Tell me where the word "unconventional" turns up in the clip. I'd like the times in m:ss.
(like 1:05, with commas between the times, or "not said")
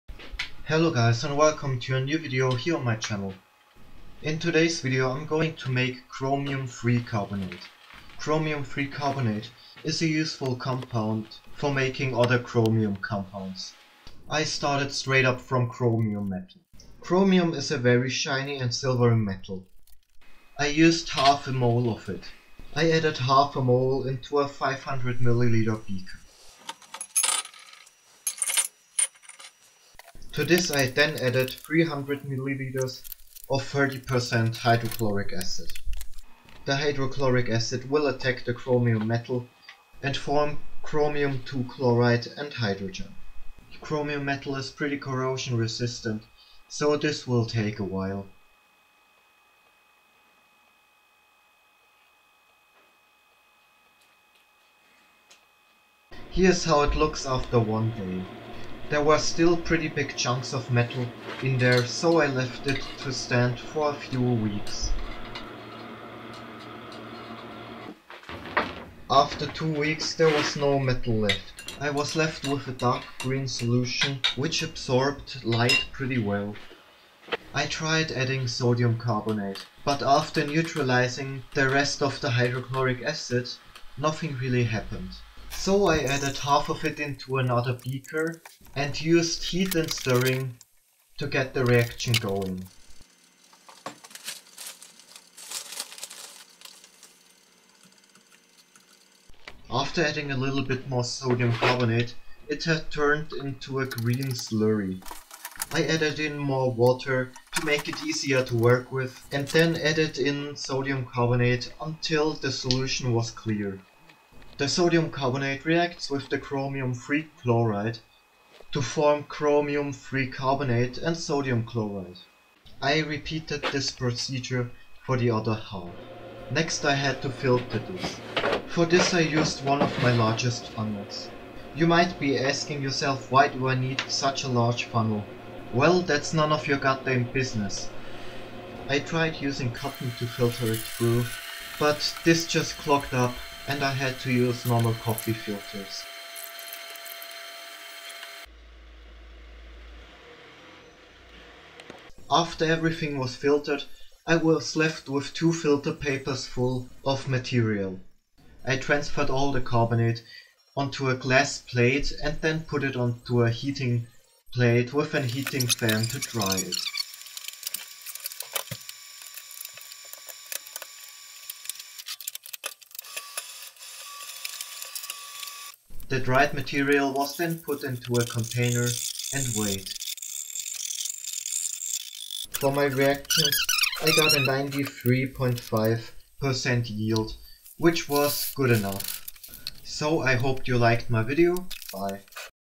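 not said.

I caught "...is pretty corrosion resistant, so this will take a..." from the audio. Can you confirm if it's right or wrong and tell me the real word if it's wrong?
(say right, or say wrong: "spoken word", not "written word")
right.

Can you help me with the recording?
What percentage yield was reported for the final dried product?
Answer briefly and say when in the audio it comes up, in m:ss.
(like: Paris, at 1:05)
93.5%, at 3:04.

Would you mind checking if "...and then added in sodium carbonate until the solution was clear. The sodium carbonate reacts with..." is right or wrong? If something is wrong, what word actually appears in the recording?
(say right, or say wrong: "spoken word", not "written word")
right.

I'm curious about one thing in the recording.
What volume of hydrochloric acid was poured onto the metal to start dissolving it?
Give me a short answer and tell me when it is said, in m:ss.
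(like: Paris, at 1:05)
300 milliliters, at 0:31.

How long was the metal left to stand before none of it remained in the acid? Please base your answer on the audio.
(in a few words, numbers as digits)
two weeks.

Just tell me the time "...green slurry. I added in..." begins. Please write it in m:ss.
1:43.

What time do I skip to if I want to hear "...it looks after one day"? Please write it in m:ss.
0:56.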